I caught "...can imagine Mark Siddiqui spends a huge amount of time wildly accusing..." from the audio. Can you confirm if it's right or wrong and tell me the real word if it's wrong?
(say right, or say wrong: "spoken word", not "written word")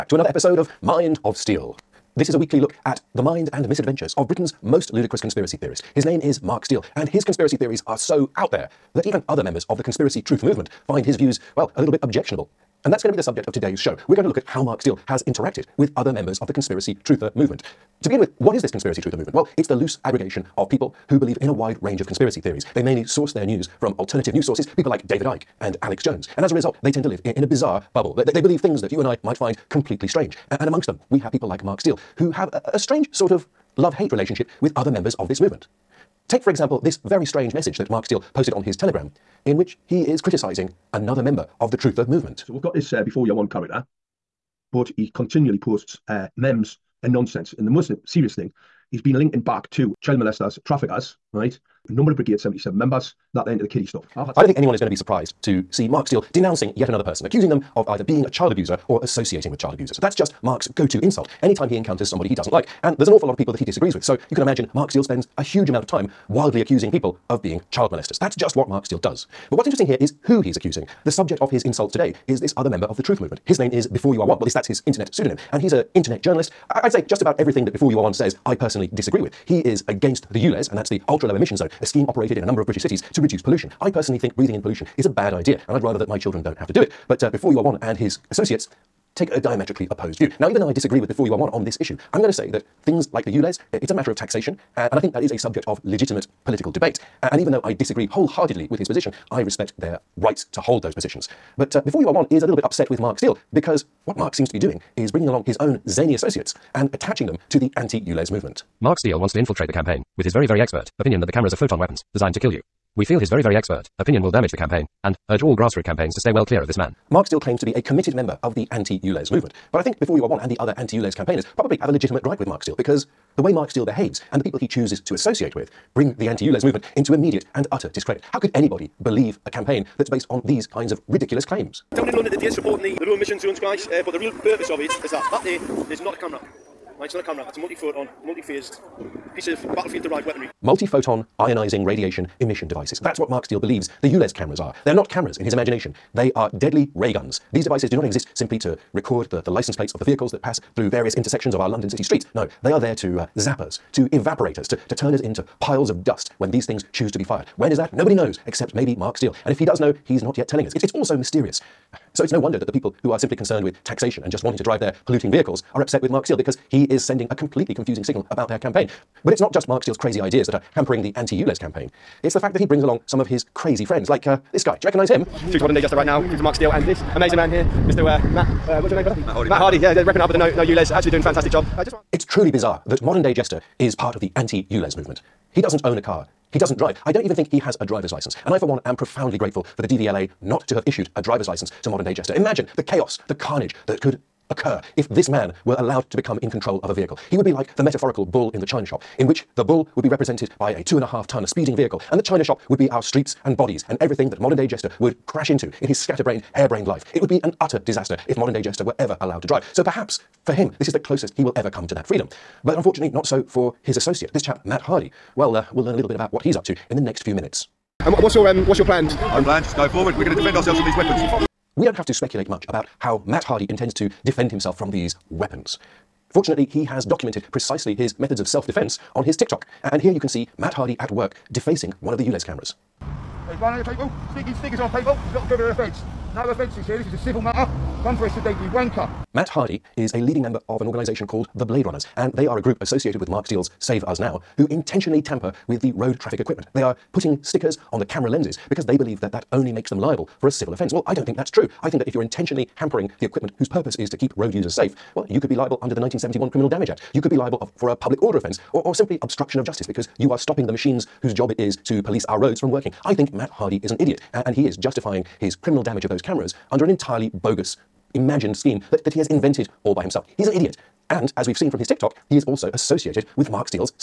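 wrong: "Steele", not "Siddiqui".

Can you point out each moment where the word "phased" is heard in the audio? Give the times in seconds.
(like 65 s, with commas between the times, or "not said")
138 s.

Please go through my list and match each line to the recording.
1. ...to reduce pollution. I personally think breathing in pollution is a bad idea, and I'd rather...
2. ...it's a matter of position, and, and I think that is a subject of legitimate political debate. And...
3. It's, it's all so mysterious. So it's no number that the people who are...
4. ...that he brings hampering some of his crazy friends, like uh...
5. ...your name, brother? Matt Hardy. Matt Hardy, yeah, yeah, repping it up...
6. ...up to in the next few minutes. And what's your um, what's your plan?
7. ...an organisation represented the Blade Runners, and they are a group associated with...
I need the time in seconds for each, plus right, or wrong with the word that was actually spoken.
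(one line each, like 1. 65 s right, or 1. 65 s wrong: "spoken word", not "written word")
1. 83 s right
2. 93 s wrong: "taxation", not "position"
3. 160 s wrong: "wonder", not "number"
4. 172 s wrong: "along", not "hampering"
5. 178 s right
6. 216 s right
7. 240 s wrong: "called", not "represented".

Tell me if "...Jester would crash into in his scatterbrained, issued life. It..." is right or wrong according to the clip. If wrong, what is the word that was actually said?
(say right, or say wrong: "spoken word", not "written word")
wrong: "harebrained", not "issued".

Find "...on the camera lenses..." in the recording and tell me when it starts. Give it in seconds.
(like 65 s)
247 s.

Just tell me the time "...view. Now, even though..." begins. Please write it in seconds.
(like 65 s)
90 s.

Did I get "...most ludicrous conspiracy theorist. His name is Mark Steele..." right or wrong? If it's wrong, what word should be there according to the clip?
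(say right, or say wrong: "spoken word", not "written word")
right.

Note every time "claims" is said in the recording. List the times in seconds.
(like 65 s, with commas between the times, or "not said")
117 s, 131 s.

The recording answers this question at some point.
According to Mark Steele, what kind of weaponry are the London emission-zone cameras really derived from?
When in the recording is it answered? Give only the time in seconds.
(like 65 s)
139 s.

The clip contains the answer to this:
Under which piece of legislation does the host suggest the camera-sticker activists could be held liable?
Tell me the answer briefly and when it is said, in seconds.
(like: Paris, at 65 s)
1971 Criminal Damage Act, at 255 s.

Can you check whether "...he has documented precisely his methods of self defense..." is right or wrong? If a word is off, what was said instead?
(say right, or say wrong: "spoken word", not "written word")
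right.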